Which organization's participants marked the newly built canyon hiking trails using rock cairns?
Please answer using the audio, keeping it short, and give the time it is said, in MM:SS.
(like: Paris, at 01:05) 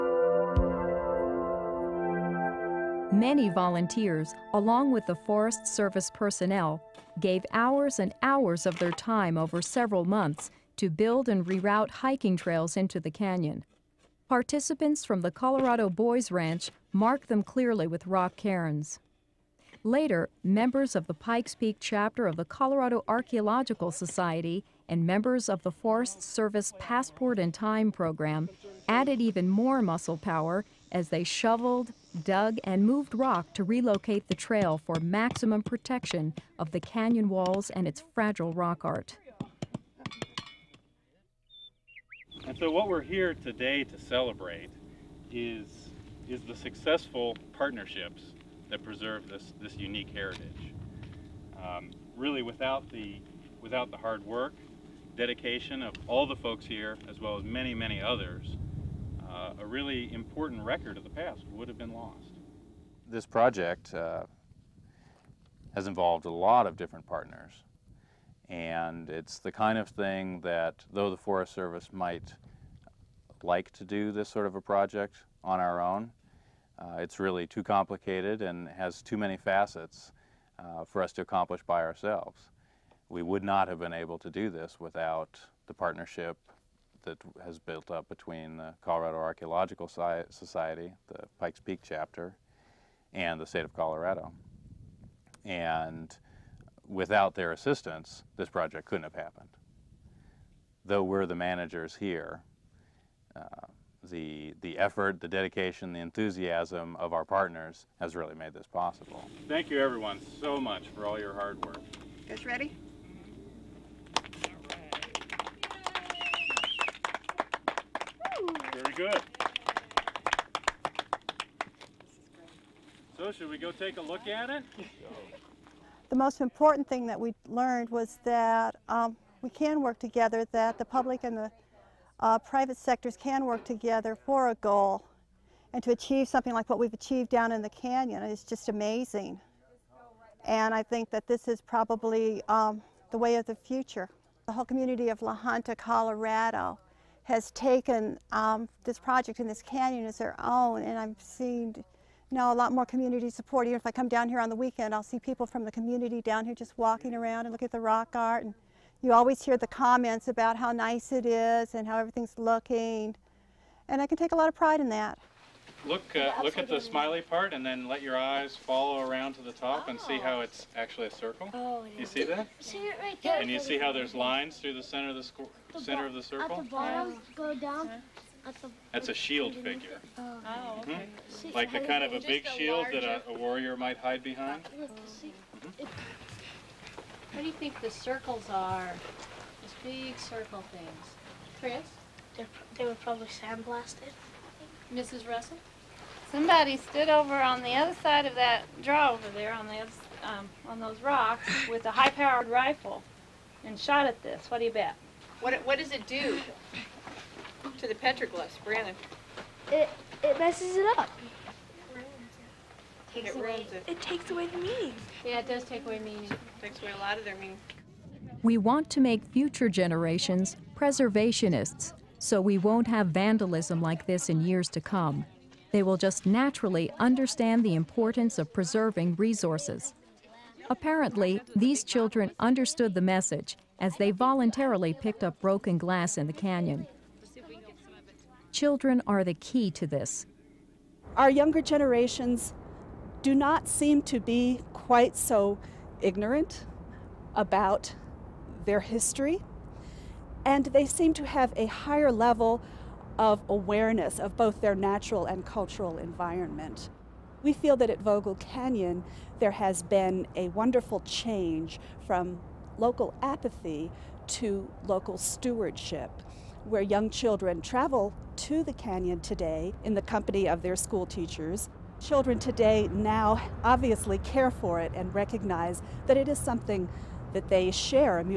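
Colorado Boys Ranch, at 00:15.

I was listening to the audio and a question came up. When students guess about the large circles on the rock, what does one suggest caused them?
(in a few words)
sandblasted.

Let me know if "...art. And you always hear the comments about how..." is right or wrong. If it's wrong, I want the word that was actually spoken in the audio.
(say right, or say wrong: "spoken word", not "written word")
right.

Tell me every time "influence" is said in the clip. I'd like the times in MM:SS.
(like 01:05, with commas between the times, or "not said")
not said.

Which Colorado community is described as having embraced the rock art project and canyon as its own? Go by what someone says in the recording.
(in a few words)
La Junta.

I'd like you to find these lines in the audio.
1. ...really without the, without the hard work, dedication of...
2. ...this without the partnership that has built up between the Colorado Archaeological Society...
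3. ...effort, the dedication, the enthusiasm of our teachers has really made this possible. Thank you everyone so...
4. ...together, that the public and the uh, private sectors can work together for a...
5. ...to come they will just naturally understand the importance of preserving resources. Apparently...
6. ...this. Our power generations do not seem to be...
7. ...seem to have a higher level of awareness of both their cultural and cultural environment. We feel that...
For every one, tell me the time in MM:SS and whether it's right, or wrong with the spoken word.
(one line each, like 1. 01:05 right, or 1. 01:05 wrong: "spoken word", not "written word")
1. 00:52 right
2. 01:24 right
3. 01:44 wrong: "partners", not "teachers"
4. 02:09 right
5. 03:44 right
6. 03:59 wrong: "younger", not "power"
7. 04:10 wrong: "natural", not "cultural".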